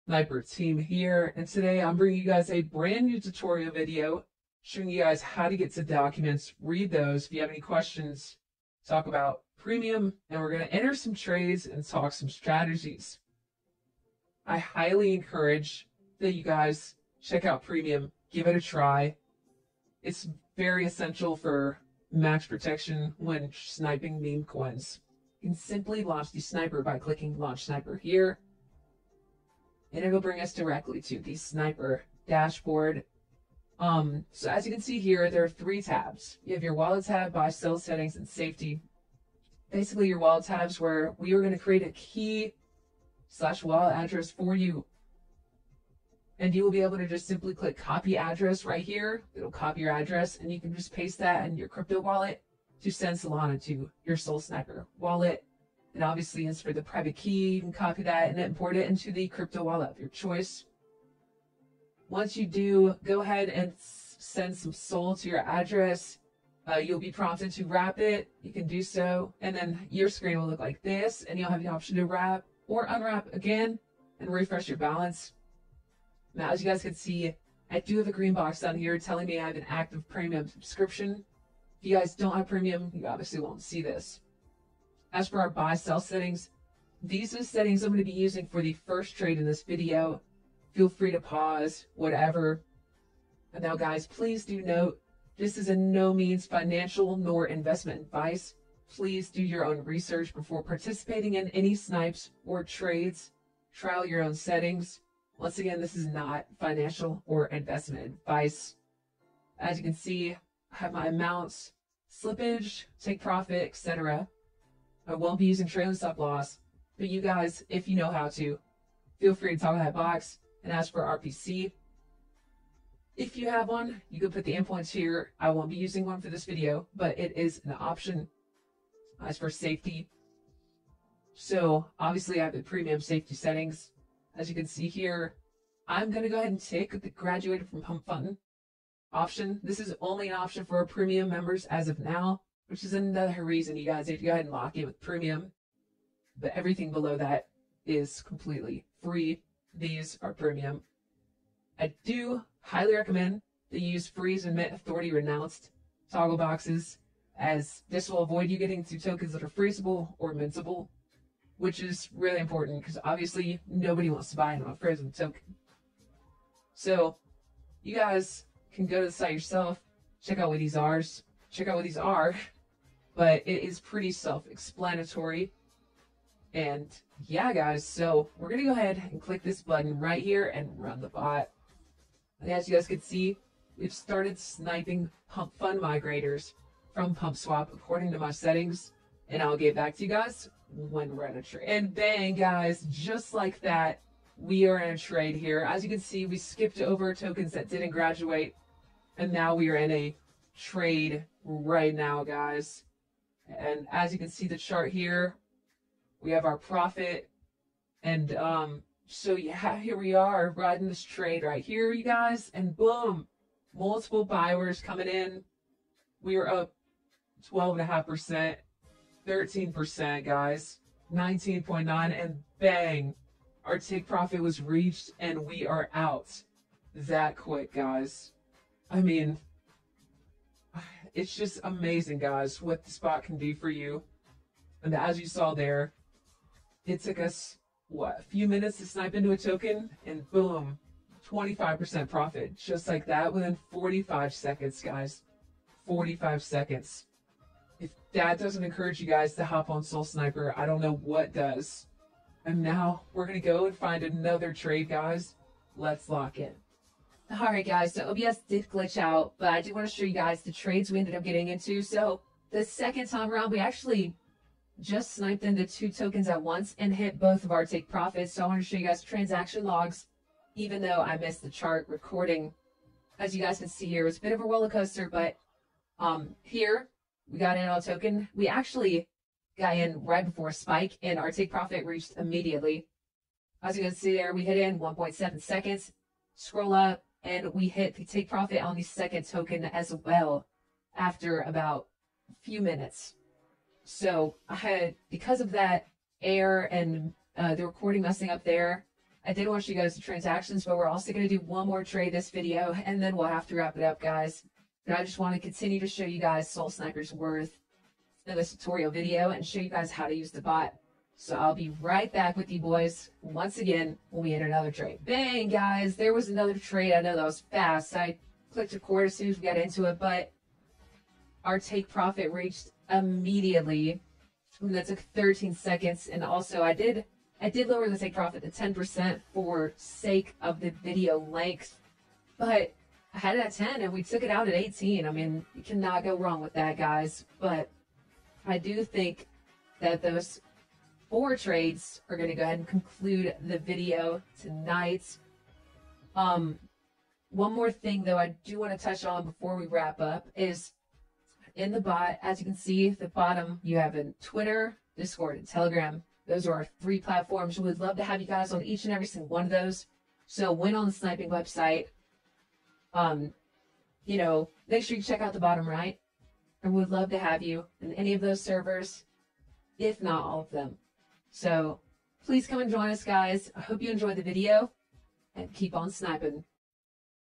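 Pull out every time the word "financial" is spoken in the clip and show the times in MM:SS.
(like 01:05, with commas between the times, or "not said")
01:36, 01:46.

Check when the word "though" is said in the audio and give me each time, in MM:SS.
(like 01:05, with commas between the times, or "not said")
04:30, 05:48.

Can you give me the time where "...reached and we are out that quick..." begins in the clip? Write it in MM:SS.
03:44.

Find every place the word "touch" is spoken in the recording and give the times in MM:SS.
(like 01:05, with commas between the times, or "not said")
05:48.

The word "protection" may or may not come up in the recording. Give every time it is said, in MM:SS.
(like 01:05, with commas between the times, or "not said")
00:22.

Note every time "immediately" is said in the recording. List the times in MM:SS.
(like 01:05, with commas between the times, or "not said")
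04:42, 05:22.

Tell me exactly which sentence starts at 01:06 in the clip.
Uh, you'll be prompted to wrap it.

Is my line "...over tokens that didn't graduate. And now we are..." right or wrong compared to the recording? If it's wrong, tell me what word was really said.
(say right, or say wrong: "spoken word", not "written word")
right.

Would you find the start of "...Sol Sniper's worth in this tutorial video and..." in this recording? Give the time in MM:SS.
05:06.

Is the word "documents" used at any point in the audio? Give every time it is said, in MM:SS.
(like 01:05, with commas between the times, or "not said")
00:05.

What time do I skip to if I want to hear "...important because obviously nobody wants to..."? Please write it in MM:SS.
02:42.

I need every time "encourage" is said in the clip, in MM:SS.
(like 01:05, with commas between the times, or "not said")
00:15, 04:08.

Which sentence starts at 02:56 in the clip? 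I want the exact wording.
And yeah, guys, so we're going to go ahead and click this button right here and run the bot.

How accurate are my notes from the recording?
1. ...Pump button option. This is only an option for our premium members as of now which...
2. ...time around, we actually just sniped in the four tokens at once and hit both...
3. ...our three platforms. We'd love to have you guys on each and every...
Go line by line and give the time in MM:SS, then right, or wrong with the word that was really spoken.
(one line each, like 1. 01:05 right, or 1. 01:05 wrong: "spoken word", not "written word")
1. 02:17 right
2. 04:23 wrong: "two", not "four"
3. 05:56 right.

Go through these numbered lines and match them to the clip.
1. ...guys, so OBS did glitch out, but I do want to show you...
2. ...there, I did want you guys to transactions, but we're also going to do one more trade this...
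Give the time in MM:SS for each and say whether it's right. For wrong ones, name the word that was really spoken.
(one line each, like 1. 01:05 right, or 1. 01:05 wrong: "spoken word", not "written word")
1. 04:17 right
2. 04:58 right.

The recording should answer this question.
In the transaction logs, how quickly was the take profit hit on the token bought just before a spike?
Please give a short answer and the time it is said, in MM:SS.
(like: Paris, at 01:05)
1.7 seconds, at 04:44.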